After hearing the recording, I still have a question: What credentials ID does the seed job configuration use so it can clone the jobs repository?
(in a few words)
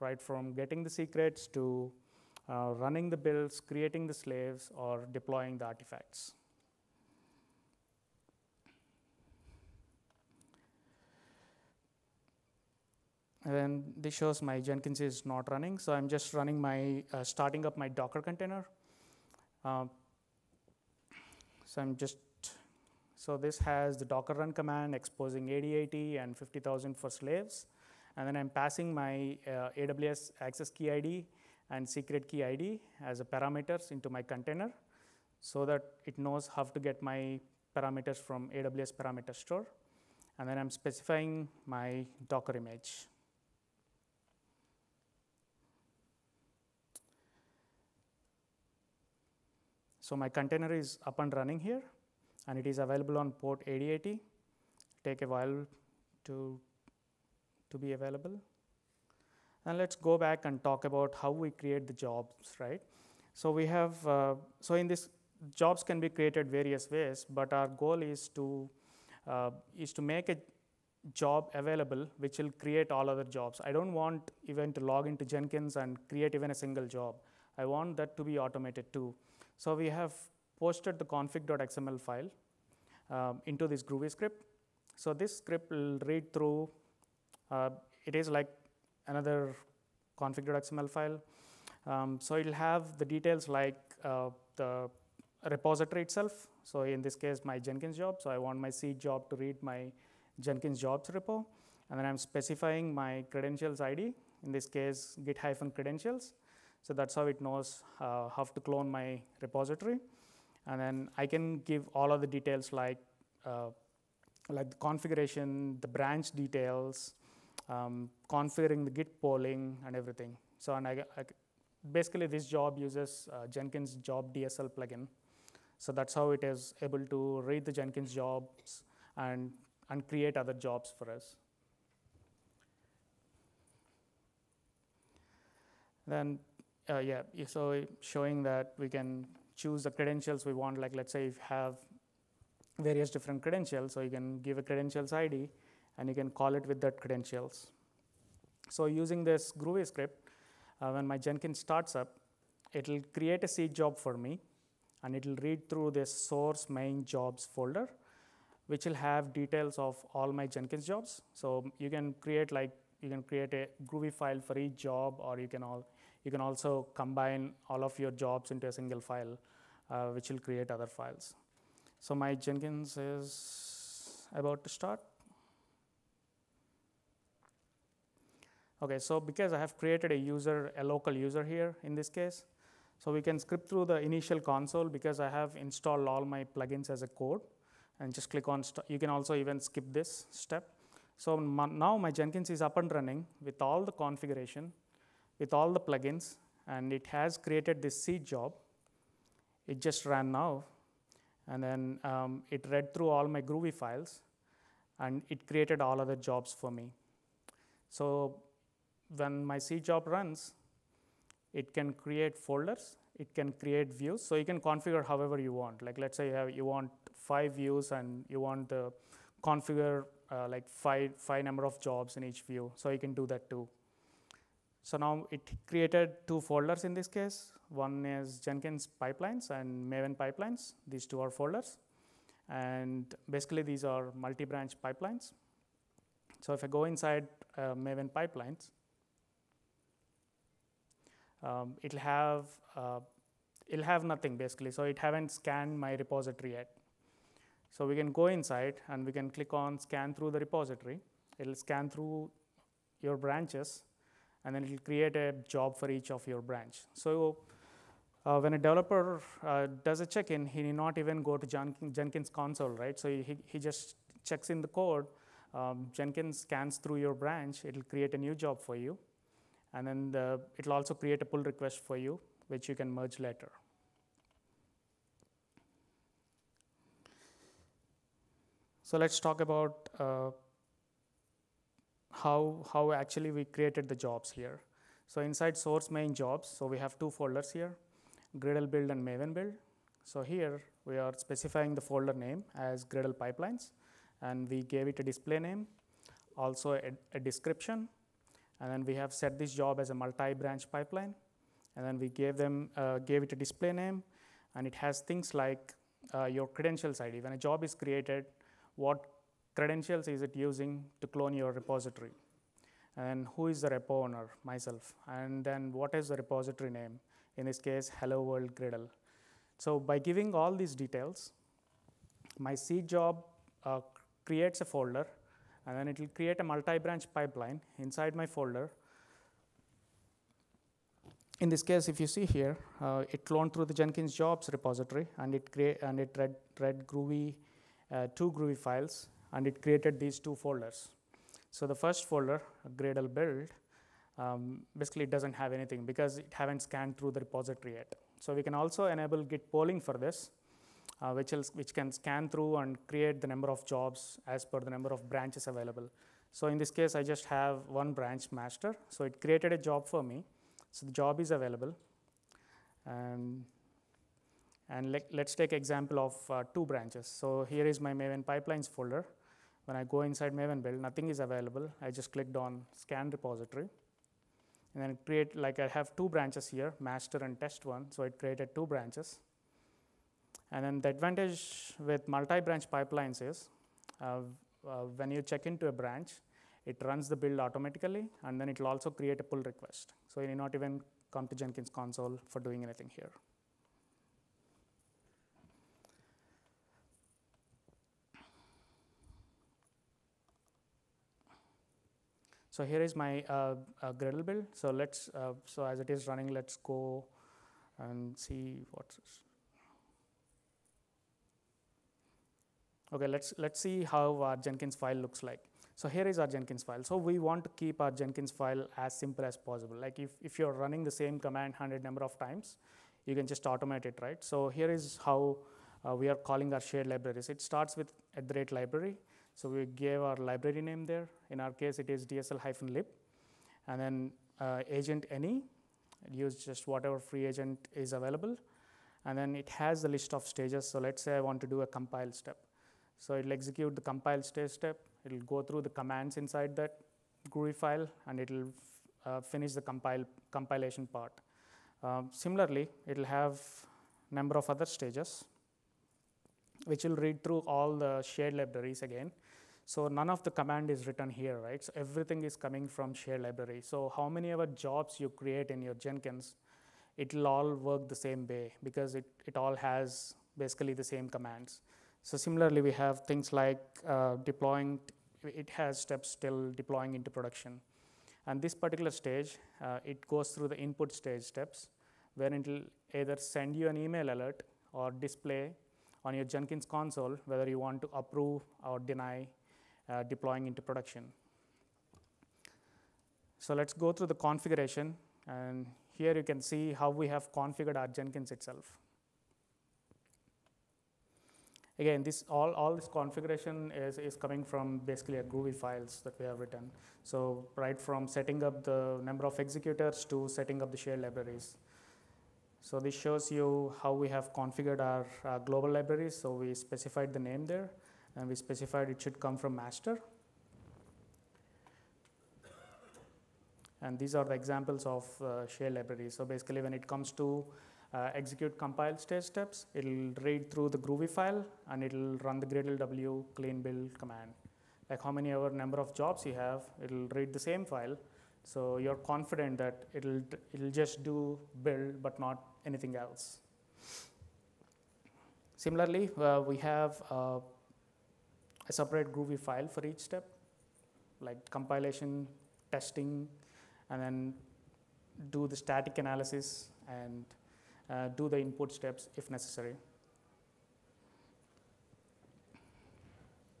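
git-credentials.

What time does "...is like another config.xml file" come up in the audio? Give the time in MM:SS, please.
01:28.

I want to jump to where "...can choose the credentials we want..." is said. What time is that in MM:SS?
02:18.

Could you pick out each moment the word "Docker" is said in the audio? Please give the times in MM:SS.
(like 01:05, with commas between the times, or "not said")
00:17, 00:24, 00:42.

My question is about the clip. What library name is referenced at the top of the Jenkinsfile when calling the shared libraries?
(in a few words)
DSL-lib.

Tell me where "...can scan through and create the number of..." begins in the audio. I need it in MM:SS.
05:51.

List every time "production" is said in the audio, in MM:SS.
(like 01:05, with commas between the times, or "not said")
07:57, 08:10.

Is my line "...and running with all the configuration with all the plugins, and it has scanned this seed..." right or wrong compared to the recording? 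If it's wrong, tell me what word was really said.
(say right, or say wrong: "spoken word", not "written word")
wrong: "created", not "scanned".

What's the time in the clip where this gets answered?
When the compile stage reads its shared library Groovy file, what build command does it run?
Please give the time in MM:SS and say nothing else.
08:52.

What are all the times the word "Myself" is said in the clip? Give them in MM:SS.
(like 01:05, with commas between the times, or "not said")
05:14.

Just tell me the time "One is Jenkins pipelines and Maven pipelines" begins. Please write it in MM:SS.
03:47.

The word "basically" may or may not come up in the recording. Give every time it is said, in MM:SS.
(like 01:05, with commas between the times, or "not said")
02:01, 03:53, 04:04, 05:44, 07:50, 08:24, 08:46.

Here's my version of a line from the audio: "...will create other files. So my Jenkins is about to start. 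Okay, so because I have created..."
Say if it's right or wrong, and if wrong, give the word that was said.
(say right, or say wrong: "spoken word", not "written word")
right.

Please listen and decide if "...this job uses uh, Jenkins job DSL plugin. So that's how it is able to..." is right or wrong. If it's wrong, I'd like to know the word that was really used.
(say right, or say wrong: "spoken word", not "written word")
right.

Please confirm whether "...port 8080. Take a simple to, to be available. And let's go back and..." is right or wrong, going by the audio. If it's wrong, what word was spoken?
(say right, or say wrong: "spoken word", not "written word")
wrong: "while", not "simple".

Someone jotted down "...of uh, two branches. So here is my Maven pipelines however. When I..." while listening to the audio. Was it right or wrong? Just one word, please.
wrong.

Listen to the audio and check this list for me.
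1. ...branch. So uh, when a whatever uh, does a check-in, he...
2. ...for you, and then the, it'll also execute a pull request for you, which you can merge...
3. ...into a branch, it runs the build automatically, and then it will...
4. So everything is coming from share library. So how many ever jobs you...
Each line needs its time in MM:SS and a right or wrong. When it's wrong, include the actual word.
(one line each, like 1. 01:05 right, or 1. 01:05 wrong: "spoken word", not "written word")
1. 04:16 wrong: "developer", not "whatever"
2. 04:28 wrong: "create", not "execute"
3. 06:25 right
4. 07:41 right.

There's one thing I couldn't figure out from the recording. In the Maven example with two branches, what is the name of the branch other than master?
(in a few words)
test one.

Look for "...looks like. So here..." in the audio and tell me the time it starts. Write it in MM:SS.
06:54.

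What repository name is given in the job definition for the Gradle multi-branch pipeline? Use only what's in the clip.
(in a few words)
hello world Gradle.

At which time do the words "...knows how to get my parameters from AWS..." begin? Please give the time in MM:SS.
00:36.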